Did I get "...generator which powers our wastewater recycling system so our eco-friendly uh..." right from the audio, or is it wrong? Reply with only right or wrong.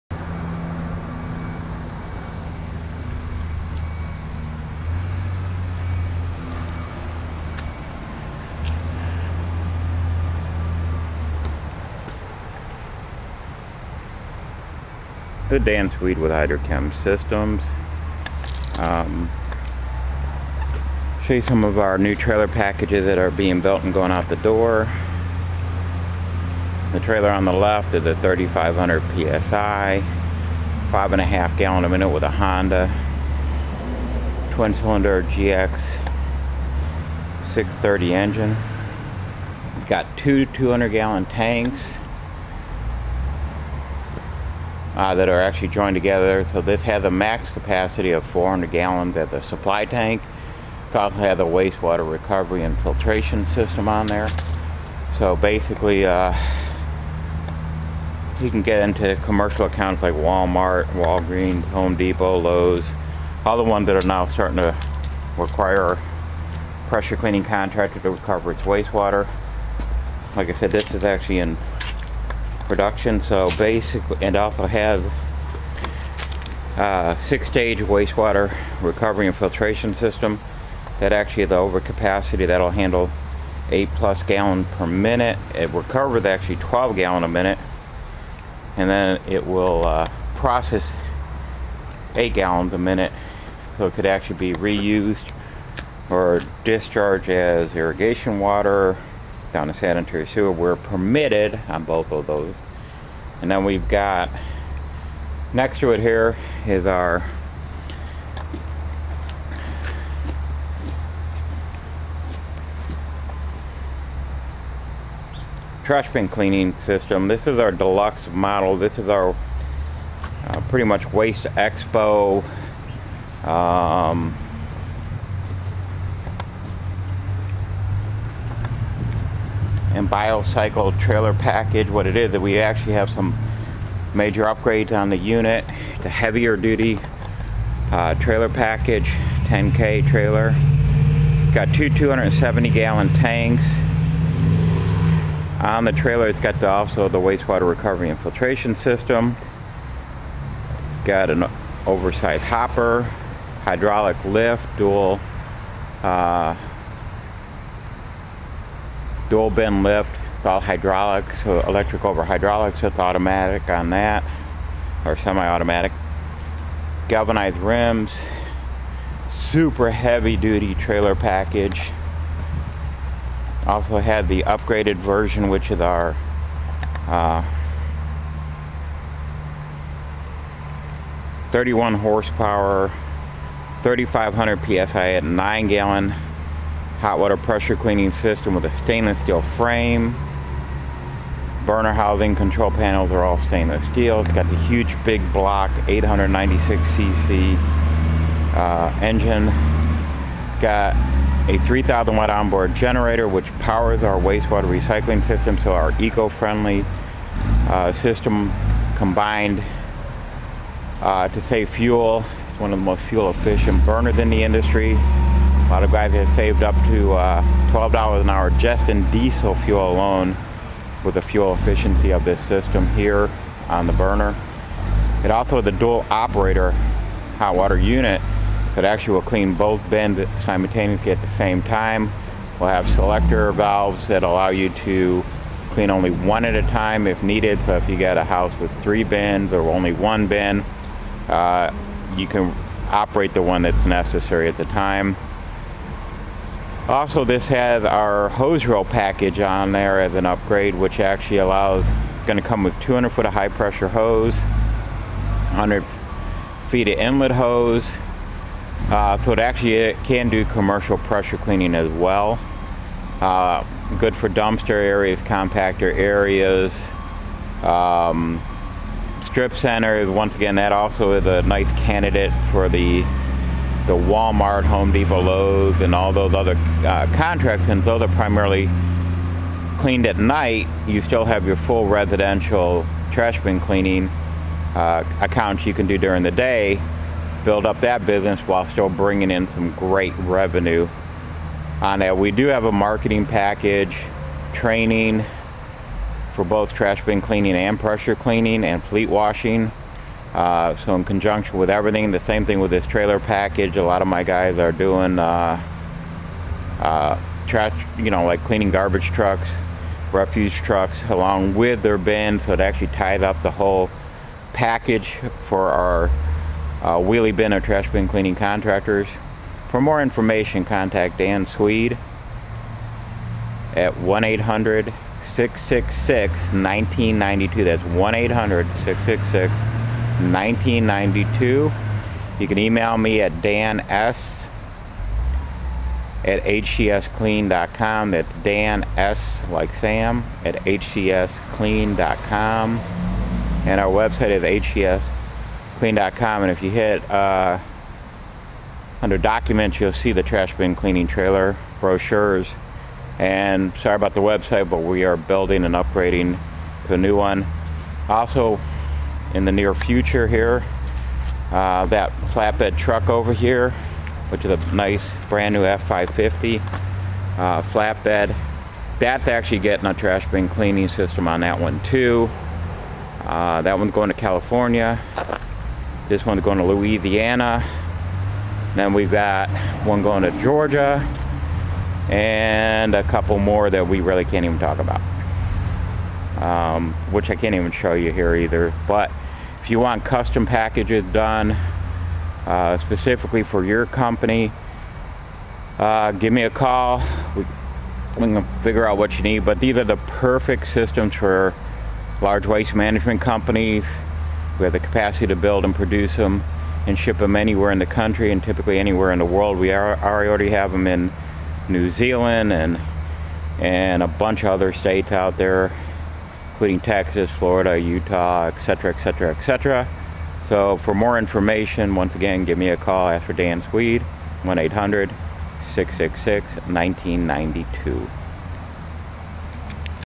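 right.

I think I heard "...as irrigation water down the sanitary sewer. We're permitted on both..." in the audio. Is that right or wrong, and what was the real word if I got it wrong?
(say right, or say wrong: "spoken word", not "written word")
right.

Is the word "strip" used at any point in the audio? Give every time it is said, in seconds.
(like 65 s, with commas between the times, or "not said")
269 s.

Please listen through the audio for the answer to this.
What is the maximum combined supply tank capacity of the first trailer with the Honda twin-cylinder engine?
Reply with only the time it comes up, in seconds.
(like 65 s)
48 s.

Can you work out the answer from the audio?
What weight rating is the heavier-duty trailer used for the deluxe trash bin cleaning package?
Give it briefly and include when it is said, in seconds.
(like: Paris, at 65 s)
10K, at 139 s.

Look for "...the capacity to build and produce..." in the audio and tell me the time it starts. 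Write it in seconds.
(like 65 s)
404 s.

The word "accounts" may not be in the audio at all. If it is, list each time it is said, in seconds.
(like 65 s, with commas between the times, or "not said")
59 s, 285 s.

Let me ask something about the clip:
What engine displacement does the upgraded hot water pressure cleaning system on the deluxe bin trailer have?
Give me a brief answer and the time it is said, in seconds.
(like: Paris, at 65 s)
896cc, at 195 s.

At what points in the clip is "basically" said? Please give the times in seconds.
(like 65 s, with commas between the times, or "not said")
55 s, 73 s.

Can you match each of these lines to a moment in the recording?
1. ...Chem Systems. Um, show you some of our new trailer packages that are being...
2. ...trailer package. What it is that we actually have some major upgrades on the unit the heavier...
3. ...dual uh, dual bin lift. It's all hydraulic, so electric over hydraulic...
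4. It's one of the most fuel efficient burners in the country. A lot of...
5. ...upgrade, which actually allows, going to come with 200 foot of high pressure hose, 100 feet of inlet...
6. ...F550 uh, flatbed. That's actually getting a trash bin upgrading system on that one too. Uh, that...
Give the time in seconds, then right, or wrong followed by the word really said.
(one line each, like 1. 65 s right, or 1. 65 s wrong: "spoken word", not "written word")
1. 16 s right
2. 130 s right
3. 154 s right
4. 212 s wrong: "industry", not "country"
5. 250 s right
6. 365 s wrong: "cleaning", not "upgrading".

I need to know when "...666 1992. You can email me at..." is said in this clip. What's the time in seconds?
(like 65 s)
328 s.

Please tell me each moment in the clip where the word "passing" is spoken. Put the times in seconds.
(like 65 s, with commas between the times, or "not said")
not said.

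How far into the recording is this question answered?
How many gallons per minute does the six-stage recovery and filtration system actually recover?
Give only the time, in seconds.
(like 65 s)
86 s.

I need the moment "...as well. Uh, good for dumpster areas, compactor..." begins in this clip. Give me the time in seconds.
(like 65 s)
261 s.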